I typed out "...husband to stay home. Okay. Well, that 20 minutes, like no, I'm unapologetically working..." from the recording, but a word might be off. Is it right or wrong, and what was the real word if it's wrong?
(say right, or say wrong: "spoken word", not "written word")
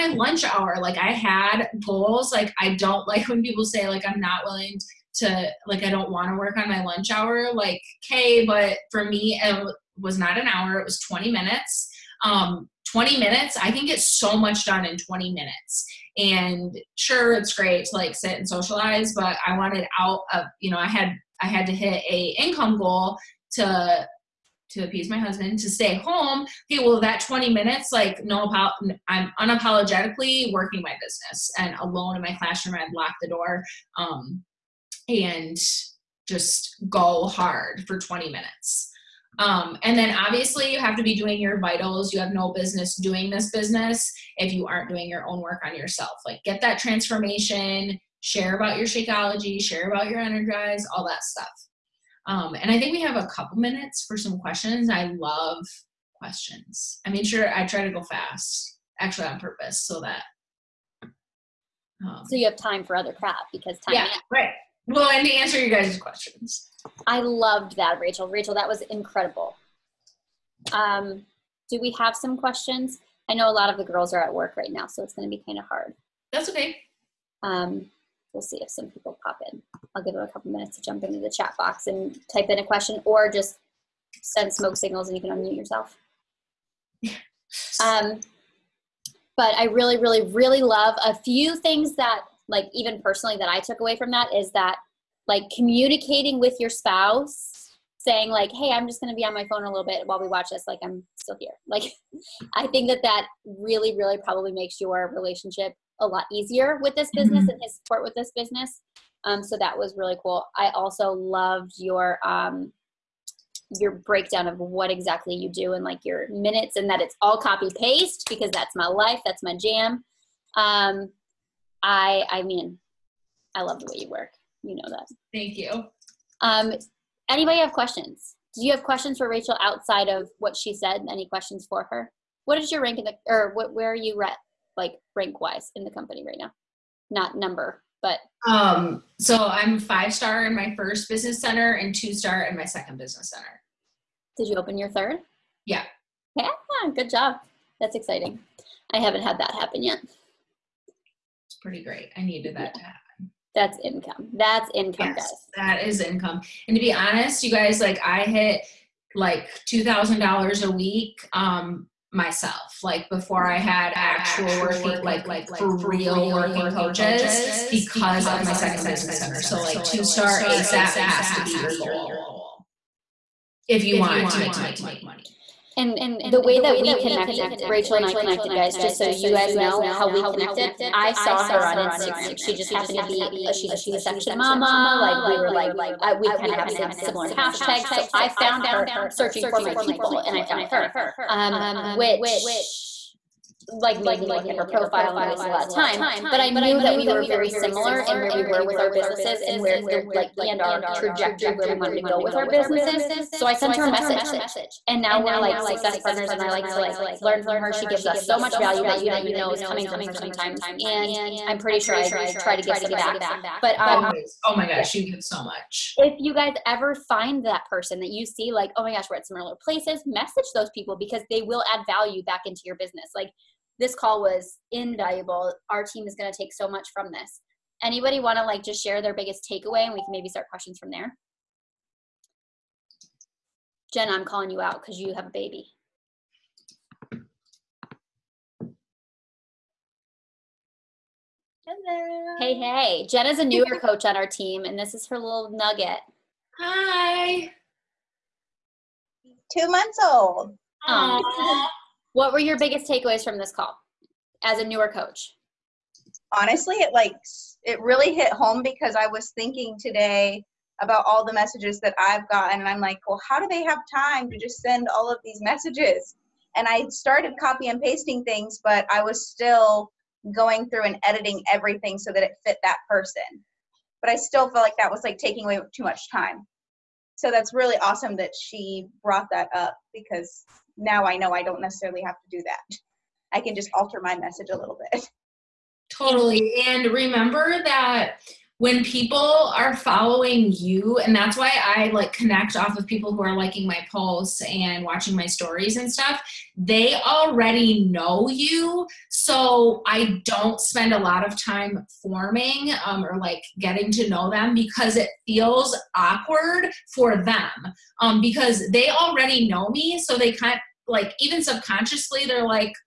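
right.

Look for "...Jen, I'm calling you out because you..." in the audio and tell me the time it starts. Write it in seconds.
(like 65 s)
233 s.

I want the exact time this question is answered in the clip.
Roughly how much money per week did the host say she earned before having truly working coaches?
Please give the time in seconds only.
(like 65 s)
159 s.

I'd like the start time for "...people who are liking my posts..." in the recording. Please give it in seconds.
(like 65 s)
292 s.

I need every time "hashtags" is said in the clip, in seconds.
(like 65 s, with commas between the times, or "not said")
187 s.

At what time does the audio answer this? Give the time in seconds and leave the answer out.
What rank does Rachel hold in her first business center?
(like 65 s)
139 s.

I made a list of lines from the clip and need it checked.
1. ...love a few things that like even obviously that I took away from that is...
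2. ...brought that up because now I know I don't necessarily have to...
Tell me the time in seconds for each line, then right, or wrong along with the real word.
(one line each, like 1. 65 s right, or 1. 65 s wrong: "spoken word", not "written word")
1. 90 s wrong: "personally", not "obviously"
2. 279 s right.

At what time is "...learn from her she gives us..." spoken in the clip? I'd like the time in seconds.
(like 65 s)
207 s.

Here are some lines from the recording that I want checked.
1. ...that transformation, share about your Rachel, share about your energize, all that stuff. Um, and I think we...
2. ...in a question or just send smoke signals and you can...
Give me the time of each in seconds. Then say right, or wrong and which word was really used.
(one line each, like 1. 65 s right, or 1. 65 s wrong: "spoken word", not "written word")
1. 46 s wrong: "Shakeology", not "Rachel"
2. 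82 s right.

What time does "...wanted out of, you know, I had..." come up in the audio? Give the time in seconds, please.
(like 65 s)
19 s.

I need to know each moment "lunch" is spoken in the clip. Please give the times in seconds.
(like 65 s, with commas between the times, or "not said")
0 s, 6 s.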